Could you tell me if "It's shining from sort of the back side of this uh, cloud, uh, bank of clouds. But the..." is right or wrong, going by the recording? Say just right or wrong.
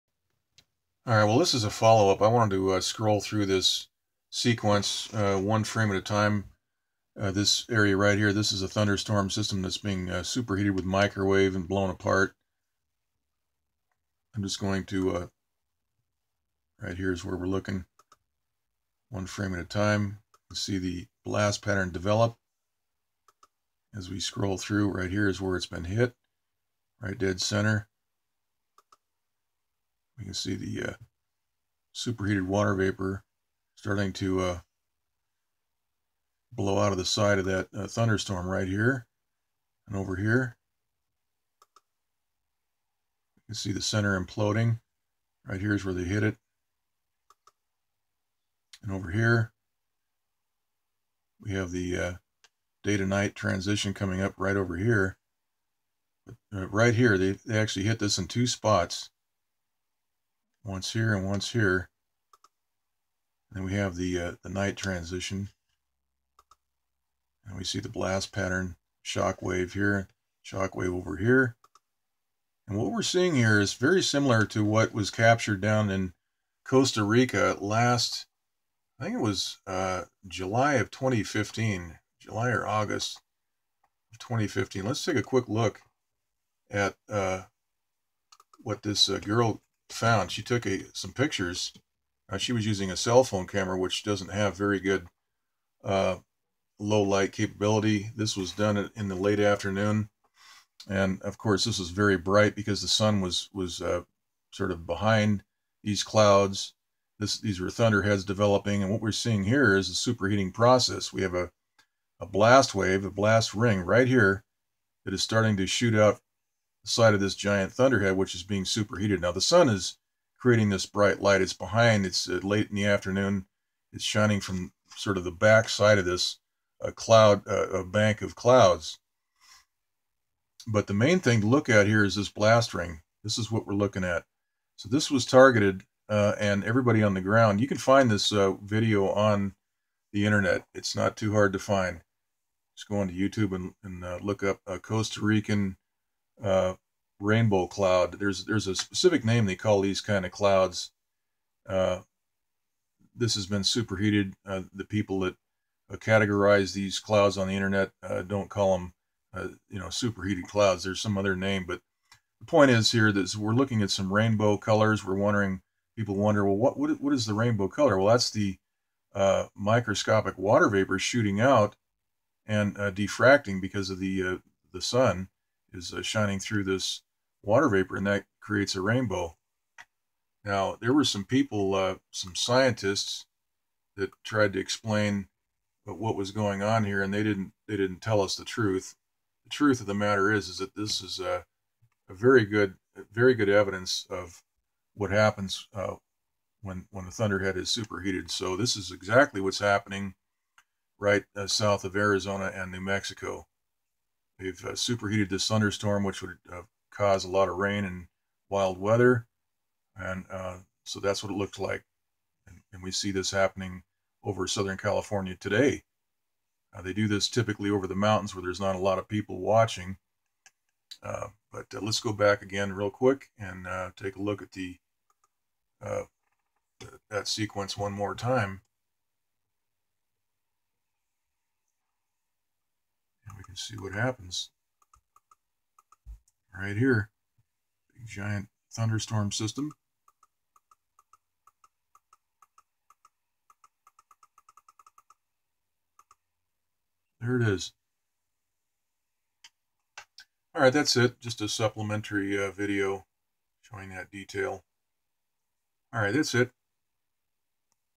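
right.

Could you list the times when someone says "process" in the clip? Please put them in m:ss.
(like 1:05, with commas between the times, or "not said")
1:50.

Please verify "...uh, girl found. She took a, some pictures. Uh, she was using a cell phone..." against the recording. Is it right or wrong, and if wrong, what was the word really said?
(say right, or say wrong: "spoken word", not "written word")
right.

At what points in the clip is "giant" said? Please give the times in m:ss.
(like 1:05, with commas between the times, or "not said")
1:57, 3:58.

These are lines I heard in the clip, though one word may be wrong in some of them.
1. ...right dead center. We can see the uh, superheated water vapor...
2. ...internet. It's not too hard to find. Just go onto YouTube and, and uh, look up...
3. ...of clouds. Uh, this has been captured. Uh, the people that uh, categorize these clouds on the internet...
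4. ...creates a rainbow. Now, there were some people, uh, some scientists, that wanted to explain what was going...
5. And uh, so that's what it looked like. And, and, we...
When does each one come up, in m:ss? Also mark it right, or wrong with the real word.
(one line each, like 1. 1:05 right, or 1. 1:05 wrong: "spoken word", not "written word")
1. 0:27 right
2. 2:20 right
3. 2:30 wrong: "superheated", not "captured"
4. 2:58 wrong: "tried", not "wanted"
5. 3:29 right.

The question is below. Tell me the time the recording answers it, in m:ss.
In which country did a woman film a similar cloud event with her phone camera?
1:16.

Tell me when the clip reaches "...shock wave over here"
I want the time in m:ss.
1:10.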